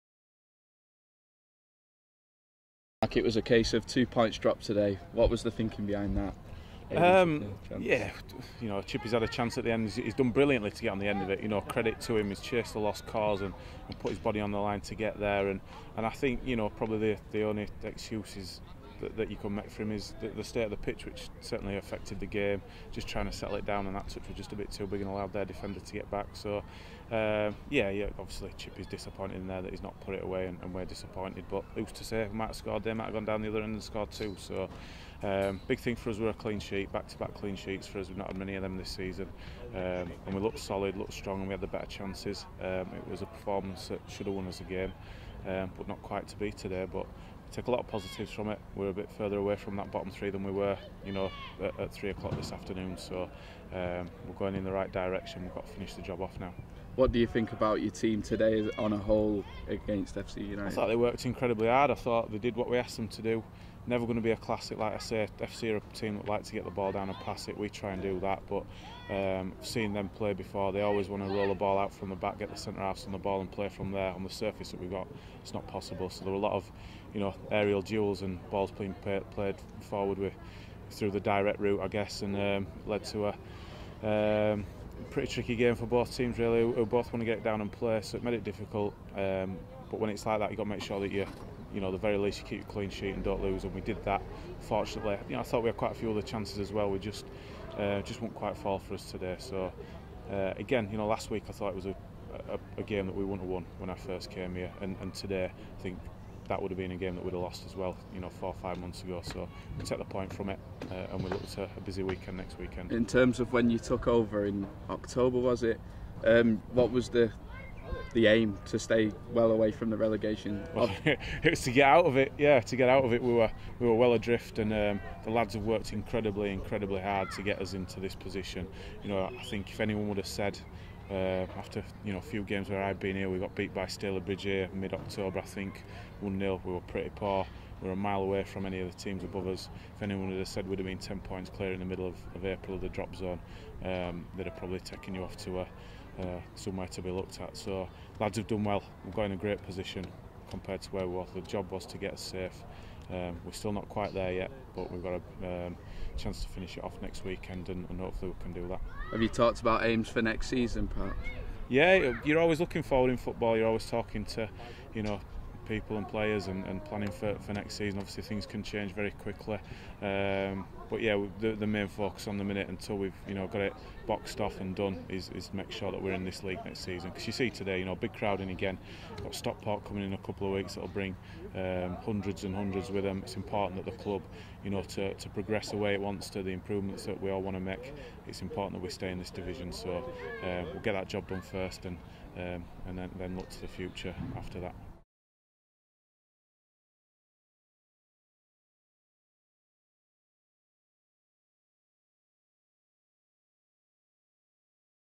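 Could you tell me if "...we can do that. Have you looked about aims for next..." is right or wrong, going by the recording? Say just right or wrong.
wrong.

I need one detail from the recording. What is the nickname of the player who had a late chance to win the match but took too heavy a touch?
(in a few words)
Chippy.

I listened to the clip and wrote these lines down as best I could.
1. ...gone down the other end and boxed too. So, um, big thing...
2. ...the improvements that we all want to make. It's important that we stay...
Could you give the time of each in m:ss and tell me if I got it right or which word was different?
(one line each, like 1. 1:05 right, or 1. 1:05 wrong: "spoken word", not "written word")
1. 0:33 wrong: "scored", not "boxed"
2. 3:06 right.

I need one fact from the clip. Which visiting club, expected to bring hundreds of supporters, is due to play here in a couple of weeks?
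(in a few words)
Stockport.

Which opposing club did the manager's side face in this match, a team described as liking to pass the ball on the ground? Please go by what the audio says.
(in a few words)
FC United.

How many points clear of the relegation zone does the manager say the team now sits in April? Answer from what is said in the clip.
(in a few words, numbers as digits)
10.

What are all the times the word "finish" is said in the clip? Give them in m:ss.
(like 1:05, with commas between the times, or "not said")
0:55, 2:36.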